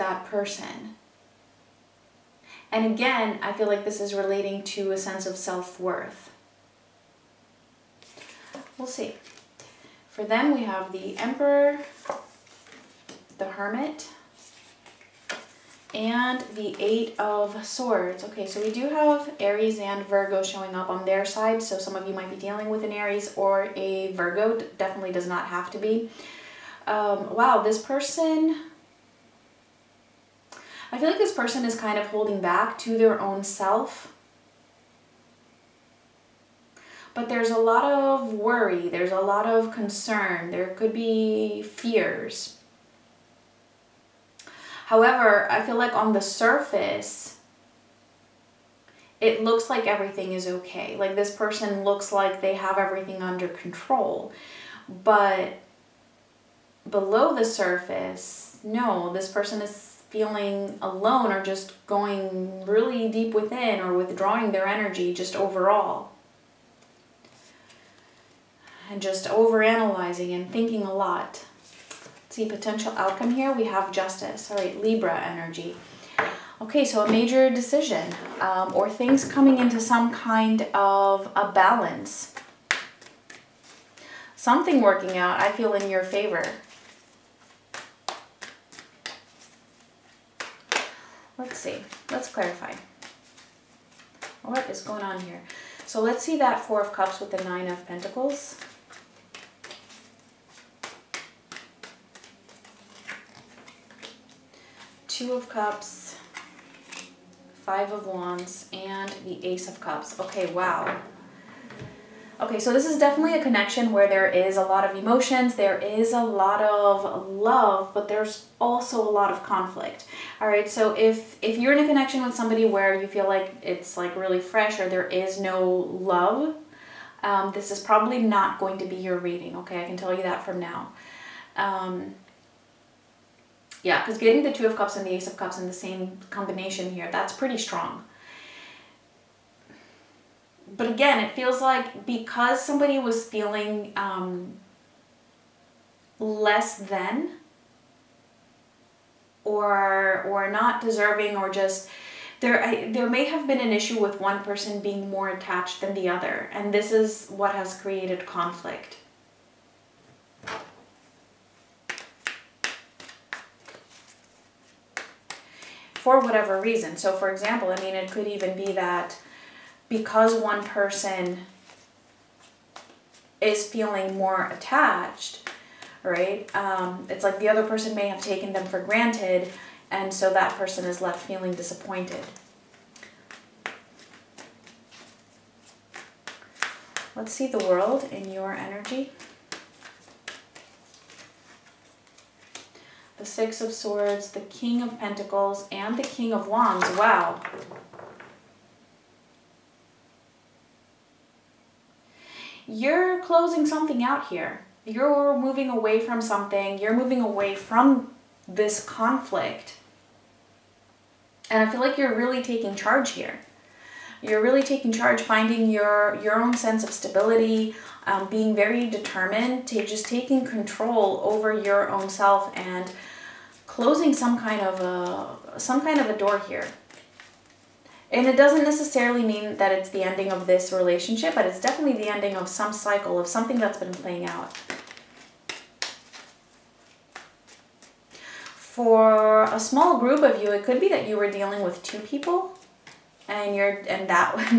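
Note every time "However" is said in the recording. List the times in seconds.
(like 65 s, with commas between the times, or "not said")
44 s.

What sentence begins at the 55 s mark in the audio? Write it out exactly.
But below the surface, no, this person is feeling alone or just going really deep within or withdrawing their energy just overall.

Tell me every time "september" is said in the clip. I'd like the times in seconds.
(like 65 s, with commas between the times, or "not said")
not said.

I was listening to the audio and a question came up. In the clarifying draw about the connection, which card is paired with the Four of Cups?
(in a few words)
Nine of Pentacles.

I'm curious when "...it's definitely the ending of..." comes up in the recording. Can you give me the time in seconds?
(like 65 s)
231 s.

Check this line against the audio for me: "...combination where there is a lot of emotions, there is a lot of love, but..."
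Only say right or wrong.
wrong.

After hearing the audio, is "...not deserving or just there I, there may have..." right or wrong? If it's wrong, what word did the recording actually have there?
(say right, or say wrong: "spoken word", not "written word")
right.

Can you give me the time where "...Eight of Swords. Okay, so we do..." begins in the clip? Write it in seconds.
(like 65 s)
16 s.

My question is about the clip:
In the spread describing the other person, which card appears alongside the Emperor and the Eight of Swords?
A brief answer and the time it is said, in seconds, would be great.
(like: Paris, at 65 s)
The Hermit, at 13 s.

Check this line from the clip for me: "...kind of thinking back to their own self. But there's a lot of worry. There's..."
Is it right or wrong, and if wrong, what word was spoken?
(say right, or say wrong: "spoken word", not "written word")
wrong: "holding", not "thinking".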